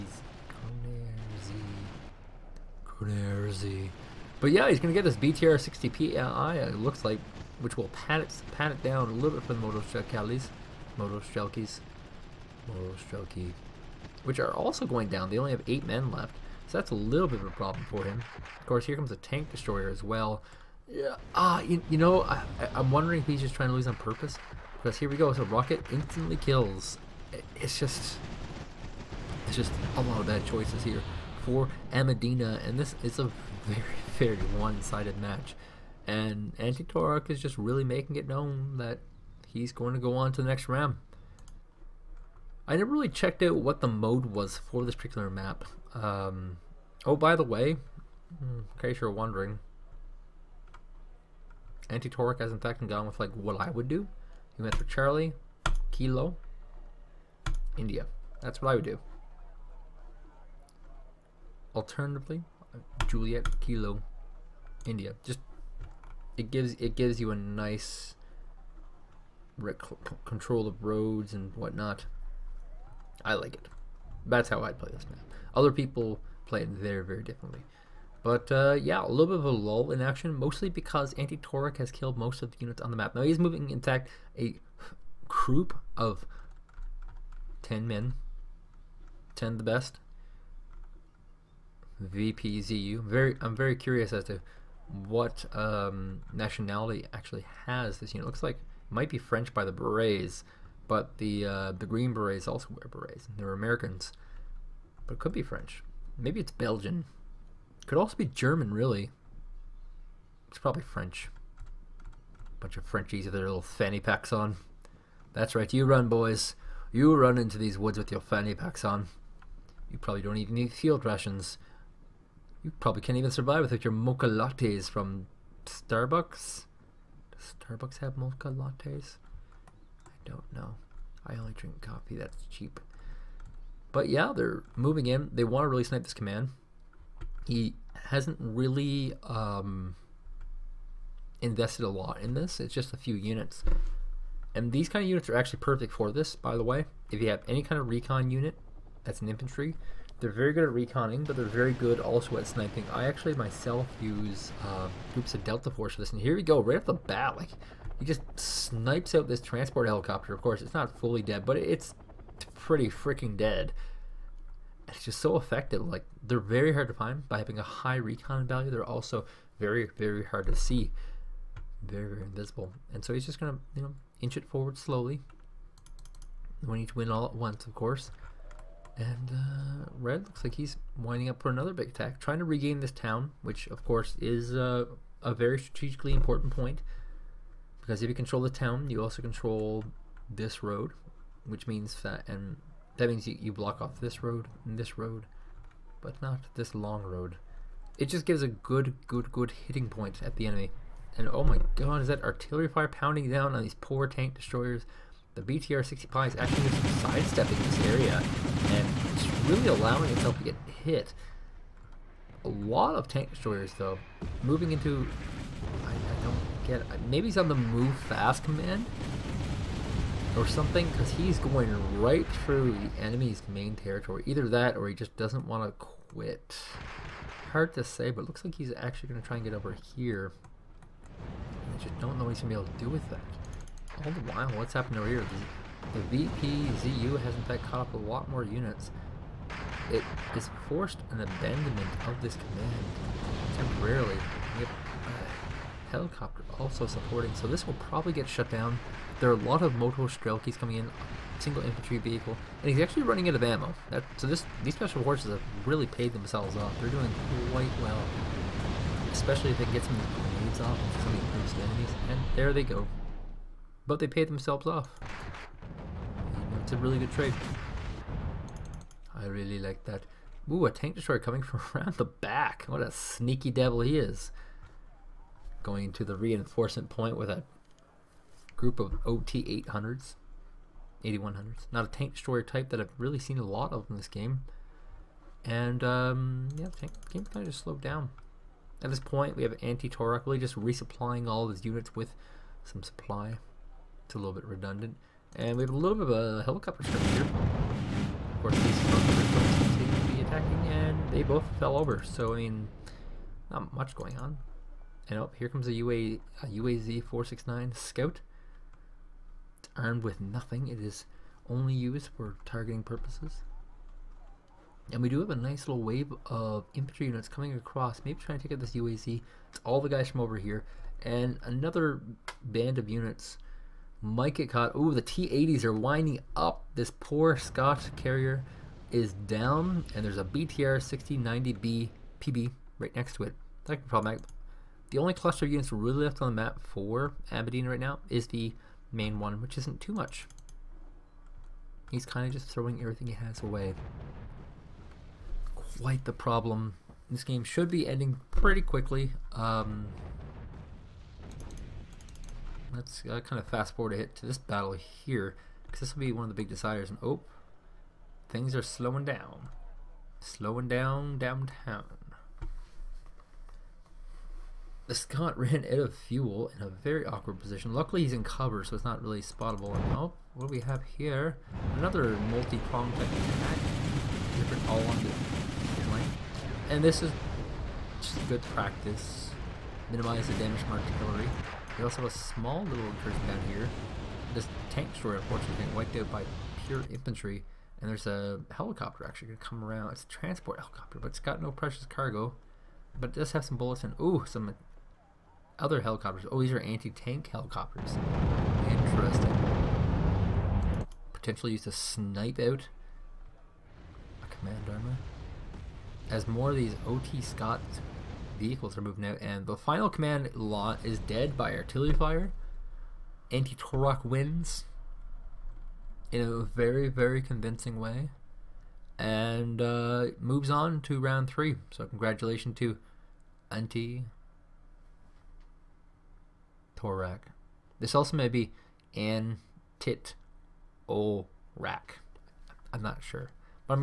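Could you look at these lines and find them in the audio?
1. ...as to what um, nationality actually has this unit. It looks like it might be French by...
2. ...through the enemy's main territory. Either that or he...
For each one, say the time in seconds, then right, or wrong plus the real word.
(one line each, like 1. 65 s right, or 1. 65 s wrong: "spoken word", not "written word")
1. 94 s right
2. 222 s right.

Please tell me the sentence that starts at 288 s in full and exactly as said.
At this point, we have anti-Torok really just resupplying all of his units with some supply.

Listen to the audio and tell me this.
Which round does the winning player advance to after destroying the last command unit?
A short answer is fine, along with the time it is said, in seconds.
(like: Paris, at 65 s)
Round three, at 420 s.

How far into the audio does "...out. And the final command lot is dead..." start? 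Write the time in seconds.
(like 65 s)
409 s.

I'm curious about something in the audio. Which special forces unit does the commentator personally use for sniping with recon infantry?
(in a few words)
Delta Force.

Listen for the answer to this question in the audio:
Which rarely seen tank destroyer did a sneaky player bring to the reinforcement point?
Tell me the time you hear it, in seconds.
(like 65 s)
281 s.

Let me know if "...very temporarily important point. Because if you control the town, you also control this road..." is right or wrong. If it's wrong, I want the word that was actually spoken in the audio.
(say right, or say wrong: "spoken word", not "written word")
wrong: "strategically", not "temporarily".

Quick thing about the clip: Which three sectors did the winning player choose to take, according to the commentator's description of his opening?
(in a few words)
Charlie, Kilo, India.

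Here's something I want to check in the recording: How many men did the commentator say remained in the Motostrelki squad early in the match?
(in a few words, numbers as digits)
8.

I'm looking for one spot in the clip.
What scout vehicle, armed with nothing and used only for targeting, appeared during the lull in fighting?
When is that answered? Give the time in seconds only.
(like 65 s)
306 s.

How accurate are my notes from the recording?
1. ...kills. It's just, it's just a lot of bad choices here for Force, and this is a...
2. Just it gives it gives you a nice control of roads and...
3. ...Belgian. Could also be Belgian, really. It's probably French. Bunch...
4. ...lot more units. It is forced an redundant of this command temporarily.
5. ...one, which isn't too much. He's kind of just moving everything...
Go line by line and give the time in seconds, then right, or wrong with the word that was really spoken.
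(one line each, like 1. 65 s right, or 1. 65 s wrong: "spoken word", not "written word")
1. 26 s wrong: "Amedina", not "Force"
2. 65 s right
3. 106 s wrong: "German", not "Belgian"
4. 237 s wrong: "abandonment", not "redundant"
5. 339 s wrong: "throwing", not "moving".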